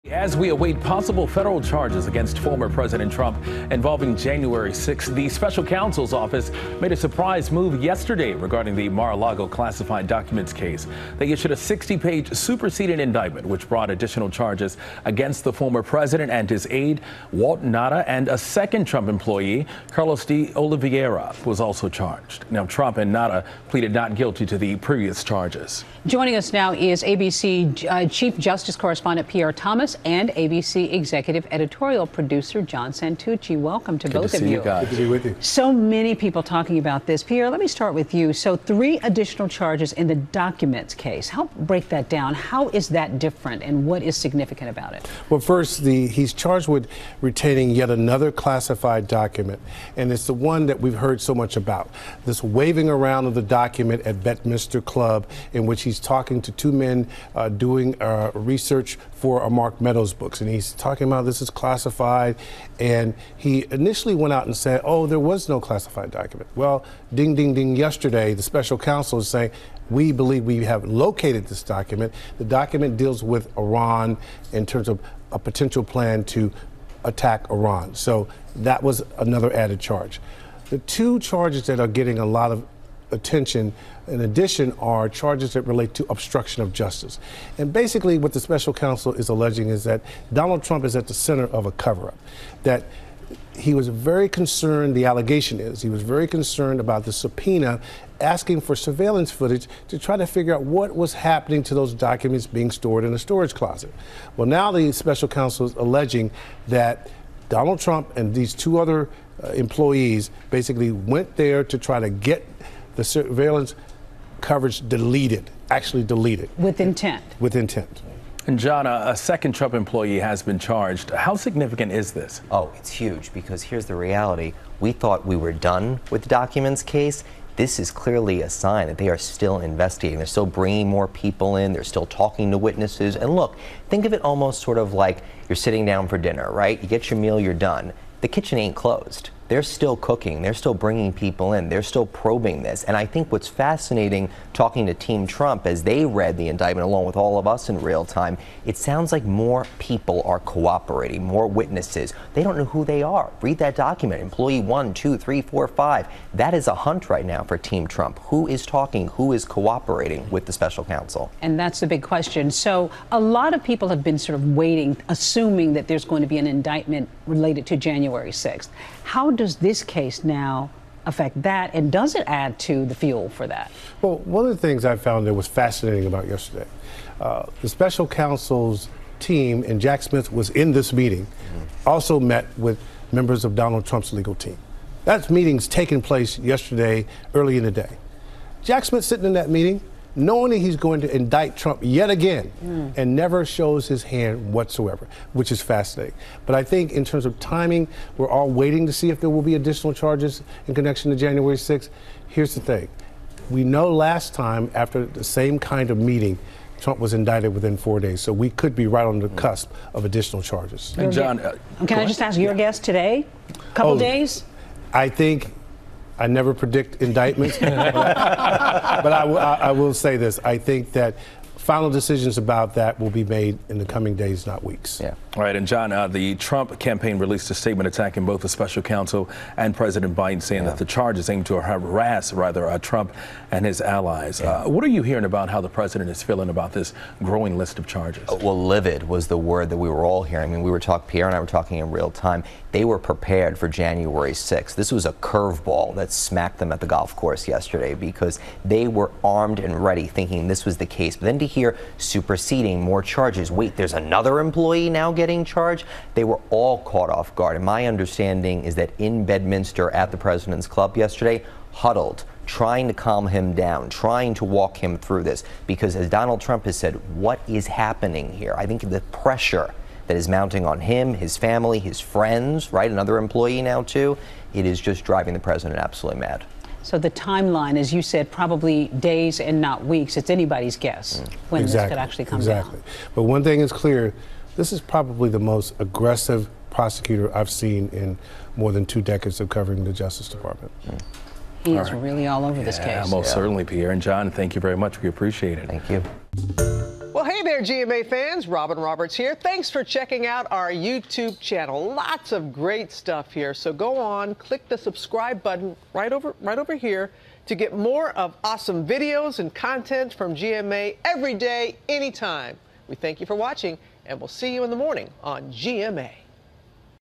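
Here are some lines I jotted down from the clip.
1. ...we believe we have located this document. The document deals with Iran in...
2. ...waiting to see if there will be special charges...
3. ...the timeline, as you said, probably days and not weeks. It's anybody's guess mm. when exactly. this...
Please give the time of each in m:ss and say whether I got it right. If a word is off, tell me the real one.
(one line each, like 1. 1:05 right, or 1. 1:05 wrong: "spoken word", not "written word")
1. 1:09 right
2. 3:18 wrong: "additional", not "special"
3. 4:36 right.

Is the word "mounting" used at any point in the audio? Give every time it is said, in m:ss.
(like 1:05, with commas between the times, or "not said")
4:30.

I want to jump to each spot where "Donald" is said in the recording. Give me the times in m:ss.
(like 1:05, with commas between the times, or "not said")
1:30, 1:47, 3:03, 4:26.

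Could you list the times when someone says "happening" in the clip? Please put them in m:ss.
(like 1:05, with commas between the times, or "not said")
1:41, 4:27.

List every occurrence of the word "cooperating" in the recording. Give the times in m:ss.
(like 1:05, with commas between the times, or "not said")
2:30, 2:39.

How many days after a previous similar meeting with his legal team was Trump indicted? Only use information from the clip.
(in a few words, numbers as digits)
4.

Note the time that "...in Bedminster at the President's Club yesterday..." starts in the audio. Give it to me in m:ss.
4:18.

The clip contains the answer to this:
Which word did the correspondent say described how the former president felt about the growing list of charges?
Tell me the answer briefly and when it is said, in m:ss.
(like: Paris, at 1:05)
Livid, at 3:58.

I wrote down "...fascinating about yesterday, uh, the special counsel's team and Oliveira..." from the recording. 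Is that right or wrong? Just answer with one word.
wrong.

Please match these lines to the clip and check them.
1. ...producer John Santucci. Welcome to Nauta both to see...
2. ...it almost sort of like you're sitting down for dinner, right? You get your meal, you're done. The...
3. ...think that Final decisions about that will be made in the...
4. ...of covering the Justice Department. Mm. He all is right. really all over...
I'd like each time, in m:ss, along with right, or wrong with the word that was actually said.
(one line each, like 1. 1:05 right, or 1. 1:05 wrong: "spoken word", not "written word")
1. 0:32 wrong: "Good", not "Nauta"
2. 2:14 right
3. 3:40 right
4. 4:49 right.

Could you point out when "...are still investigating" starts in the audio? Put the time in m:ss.
2:09.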